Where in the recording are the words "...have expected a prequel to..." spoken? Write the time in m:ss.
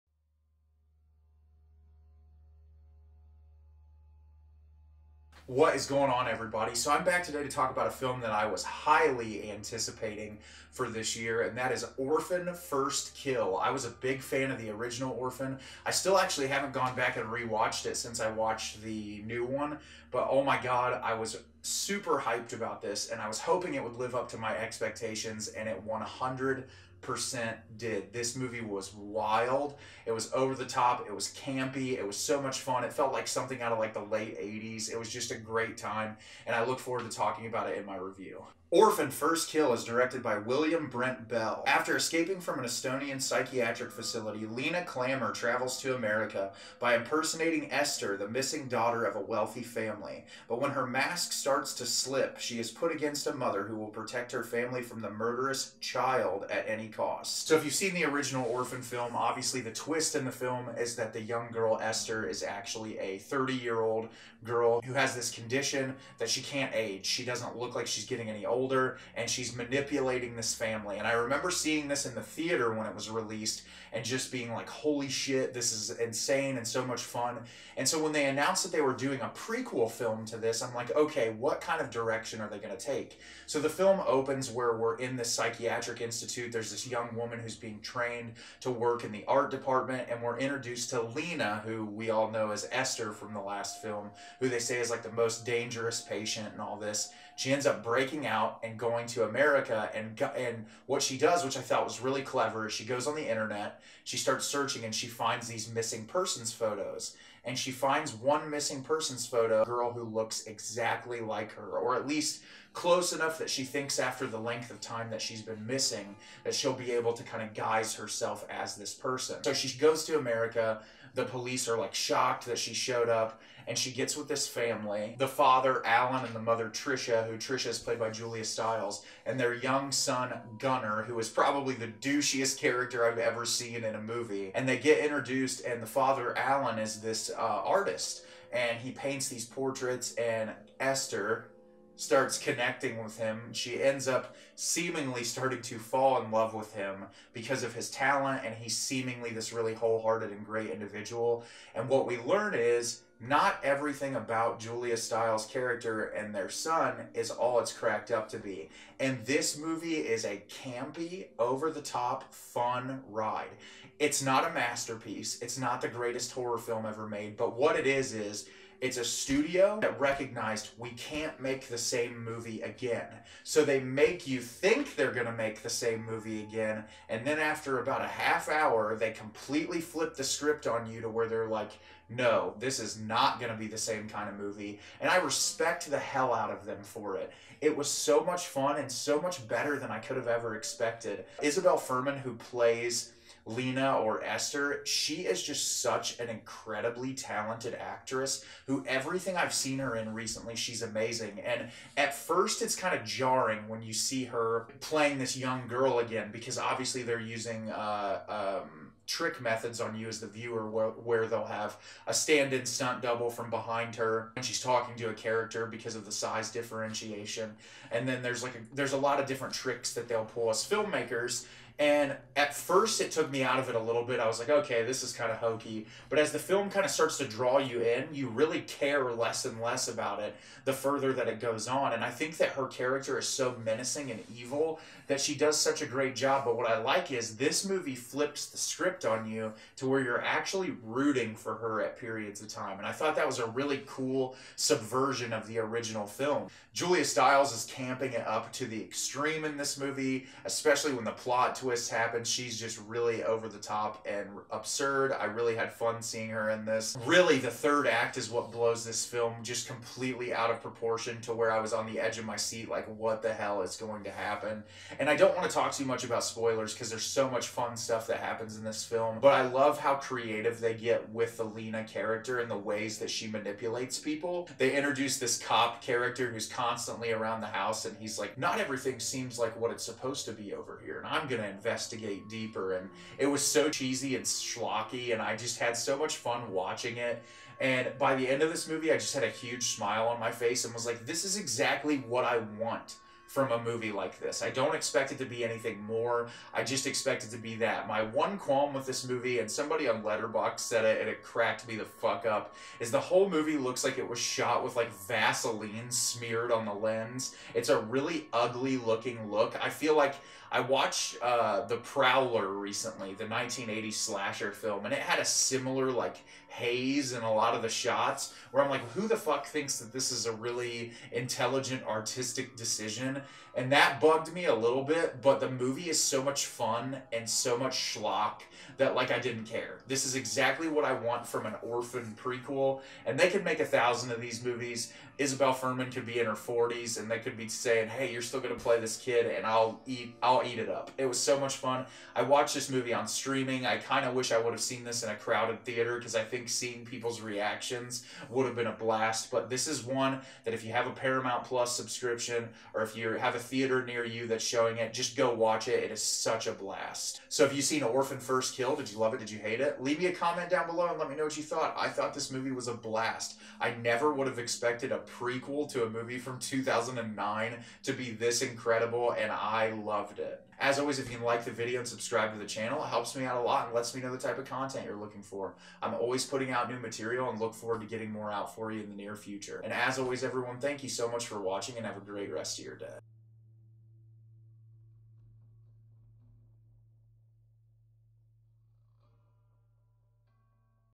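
6:04.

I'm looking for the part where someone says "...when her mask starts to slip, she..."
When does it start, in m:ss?
0:50.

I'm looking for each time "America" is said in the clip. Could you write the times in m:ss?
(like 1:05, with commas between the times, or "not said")
0:45, 1:39, 2:00.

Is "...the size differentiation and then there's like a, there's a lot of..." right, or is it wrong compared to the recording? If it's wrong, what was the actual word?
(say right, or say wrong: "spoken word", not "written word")
right.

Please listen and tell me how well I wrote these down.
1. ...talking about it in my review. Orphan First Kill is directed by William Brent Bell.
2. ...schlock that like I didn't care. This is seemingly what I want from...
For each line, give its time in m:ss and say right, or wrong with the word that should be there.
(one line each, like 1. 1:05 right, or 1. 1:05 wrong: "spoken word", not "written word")
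1. 0:37 right
2. 5:27 wrong: "exactly", not "seemingly".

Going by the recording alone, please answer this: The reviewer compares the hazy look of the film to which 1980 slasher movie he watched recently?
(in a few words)
The Prowler.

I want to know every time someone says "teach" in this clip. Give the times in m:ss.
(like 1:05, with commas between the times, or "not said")
not said.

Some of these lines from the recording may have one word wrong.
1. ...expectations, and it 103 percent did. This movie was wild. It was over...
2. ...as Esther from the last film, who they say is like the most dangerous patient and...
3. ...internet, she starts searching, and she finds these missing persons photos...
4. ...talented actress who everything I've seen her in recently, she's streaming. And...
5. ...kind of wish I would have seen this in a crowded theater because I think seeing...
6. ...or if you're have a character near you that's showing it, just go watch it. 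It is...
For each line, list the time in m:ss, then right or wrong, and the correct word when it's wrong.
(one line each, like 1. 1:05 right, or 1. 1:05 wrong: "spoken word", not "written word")
1. 0:24 wrong: "100", not "103"
2. 1:32 right
3. 1:43 right
4. 3:17 wrong: "amazing", not "streaming"
5. 5:43 right
6. 5:52 wrong: "theater", not "character".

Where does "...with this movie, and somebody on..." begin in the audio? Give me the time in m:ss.
4:58.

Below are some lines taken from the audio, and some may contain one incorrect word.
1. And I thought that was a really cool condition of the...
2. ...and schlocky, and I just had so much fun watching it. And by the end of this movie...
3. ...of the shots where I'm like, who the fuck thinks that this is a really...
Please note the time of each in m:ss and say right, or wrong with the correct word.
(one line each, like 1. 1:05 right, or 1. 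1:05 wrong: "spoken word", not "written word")
1. 4:02 wrong: "subversion", not "condition"
2. 4:44 right
3. 5:17 right.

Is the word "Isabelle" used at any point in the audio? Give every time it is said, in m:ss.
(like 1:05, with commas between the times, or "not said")
3:11, 5:35.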